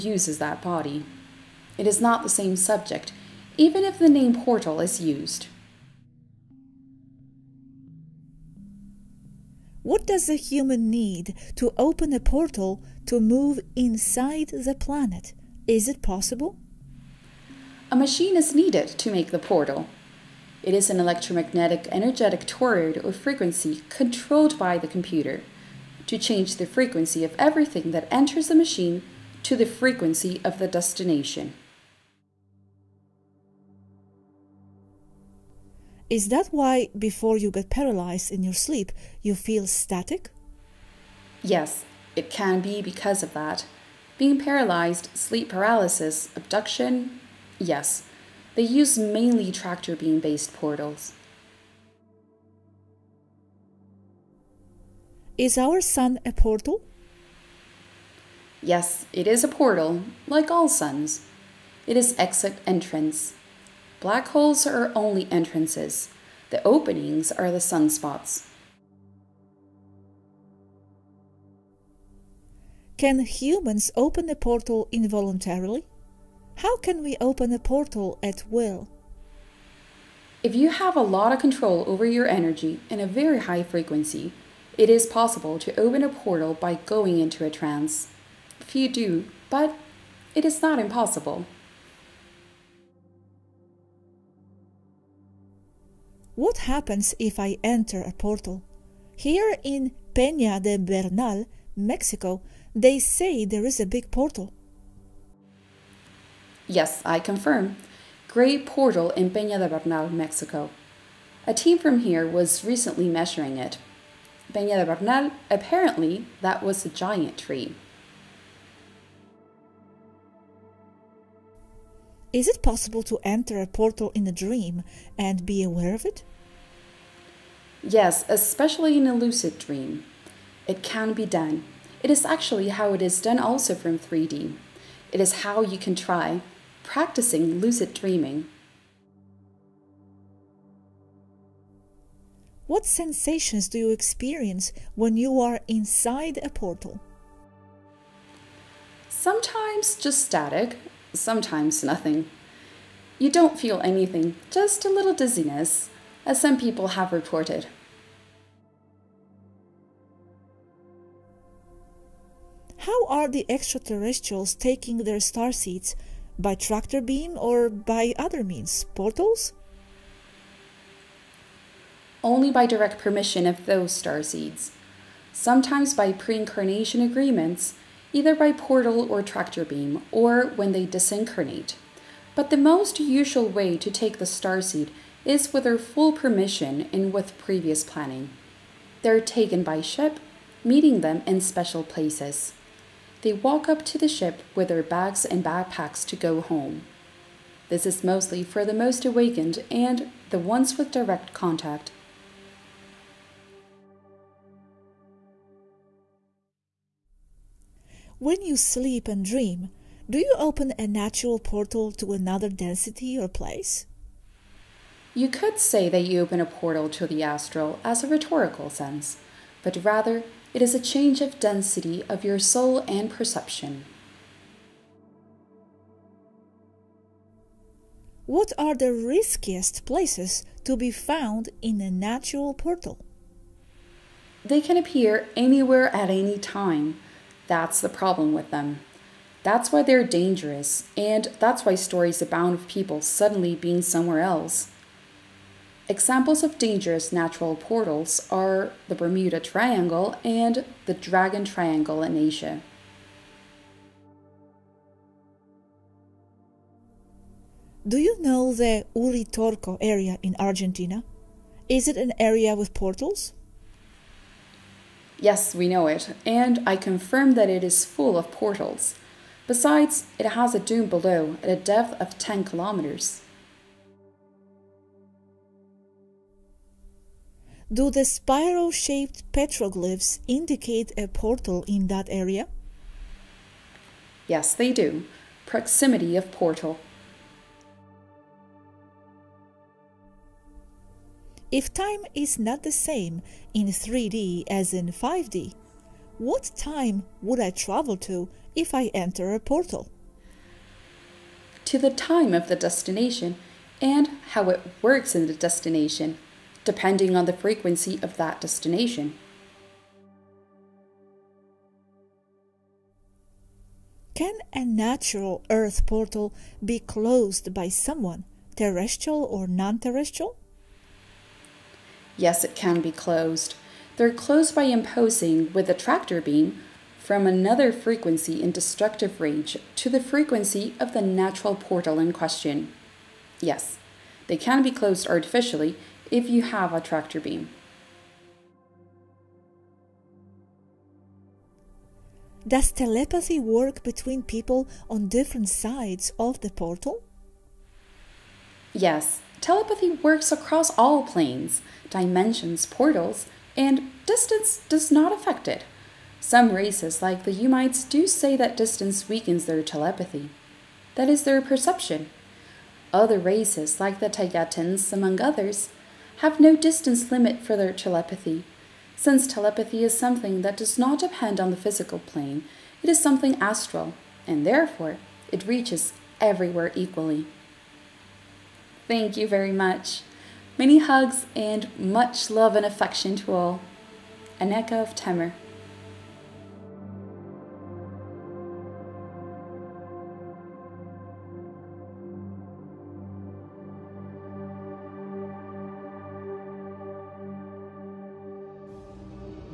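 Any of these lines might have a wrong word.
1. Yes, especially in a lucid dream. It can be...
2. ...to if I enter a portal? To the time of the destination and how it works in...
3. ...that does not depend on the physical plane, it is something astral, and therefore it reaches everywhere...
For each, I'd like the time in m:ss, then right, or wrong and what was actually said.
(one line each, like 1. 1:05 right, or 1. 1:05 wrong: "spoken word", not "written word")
1. 2:07 right
2. 4:57 right
3. 6:10 right.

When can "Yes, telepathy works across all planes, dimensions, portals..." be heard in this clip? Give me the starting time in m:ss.
5:48.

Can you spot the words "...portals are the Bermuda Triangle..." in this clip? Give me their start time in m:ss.
4:07.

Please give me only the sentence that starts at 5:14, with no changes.
Can a natural Earth portal be closed by someone, terrestrial or non terrestrial?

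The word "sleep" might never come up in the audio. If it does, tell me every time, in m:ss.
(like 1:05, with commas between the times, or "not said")
0:38, 0:45, 3:28.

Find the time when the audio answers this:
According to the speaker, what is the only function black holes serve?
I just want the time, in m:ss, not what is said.
1:03.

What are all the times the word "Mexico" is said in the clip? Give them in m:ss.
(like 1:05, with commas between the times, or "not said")
1:41, 1:50.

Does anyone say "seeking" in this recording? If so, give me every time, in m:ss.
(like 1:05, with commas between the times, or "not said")
not said.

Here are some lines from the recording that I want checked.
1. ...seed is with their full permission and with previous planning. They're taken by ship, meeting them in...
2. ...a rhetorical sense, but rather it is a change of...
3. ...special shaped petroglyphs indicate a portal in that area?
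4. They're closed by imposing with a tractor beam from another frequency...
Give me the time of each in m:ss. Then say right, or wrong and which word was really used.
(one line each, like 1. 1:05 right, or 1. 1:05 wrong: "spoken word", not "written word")
1. 3:04 right
2. 3:38 right
3. 4:38 wrong: "spiral", not "special"
4. 5:23 right.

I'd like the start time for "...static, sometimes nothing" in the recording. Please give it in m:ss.
2:30.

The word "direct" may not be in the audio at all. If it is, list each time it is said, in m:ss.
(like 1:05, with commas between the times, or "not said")
2:52, 3:20.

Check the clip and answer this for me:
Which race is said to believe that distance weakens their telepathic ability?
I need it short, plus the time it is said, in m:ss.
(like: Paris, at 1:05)
The Ummites, at 5:57.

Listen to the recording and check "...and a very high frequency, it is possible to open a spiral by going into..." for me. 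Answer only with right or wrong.
wrong.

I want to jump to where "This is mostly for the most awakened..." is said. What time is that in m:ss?
3:17.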